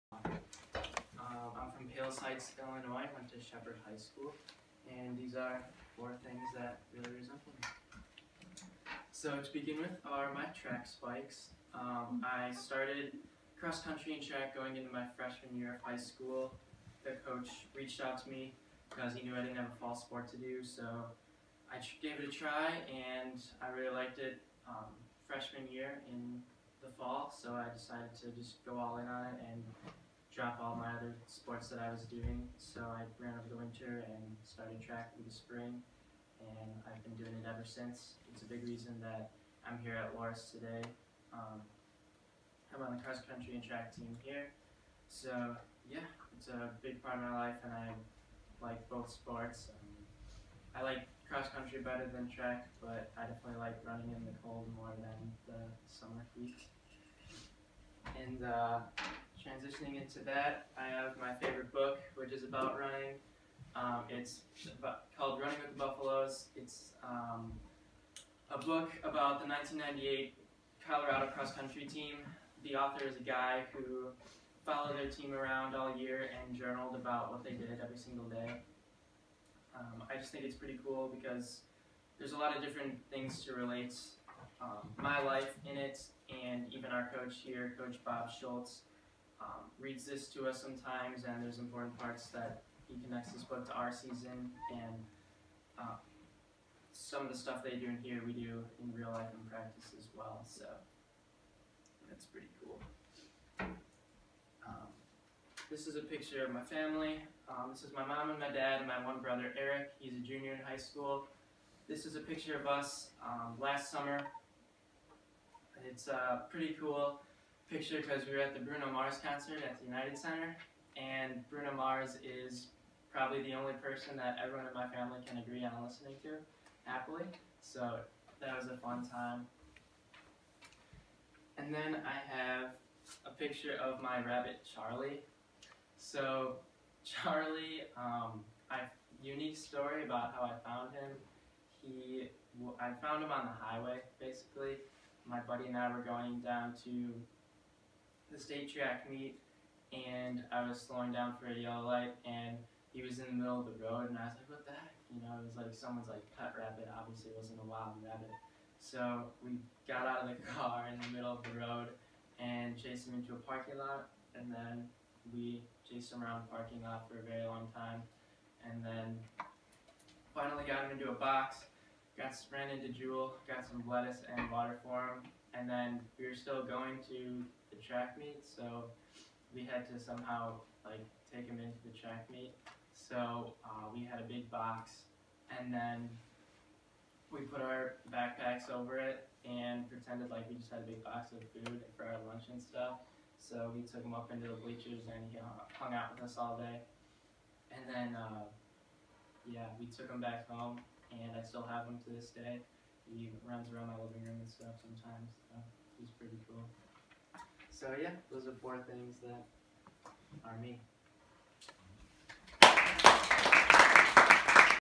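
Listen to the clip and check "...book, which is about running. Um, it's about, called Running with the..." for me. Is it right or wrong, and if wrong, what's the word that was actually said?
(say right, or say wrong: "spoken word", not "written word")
right.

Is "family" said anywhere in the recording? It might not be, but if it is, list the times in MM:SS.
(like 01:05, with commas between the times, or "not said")
01:46, 02:04.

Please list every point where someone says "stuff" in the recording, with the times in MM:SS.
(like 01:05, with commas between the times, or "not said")
01:37, 03:12, 03:24.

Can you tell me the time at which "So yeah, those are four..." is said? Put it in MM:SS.
03:27.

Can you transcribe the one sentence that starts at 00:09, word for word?
So to begin with are my track spikes.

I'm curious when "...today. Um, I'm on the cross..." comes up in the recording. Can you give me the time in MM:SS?
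00:40.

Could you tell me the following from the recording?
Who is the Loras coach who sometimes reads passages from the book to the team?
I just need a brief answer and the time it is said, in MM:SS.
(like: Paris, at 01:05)
Coach Bob Schultz, at 01:27.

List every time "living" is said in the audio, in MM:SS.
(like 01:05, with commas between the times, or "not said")
03:23.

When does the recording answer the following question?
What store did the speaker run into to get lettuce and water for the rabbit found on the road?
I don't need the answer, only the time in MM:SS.
02:52.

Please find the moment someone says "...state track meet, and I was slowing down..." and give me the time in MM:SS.
02:28.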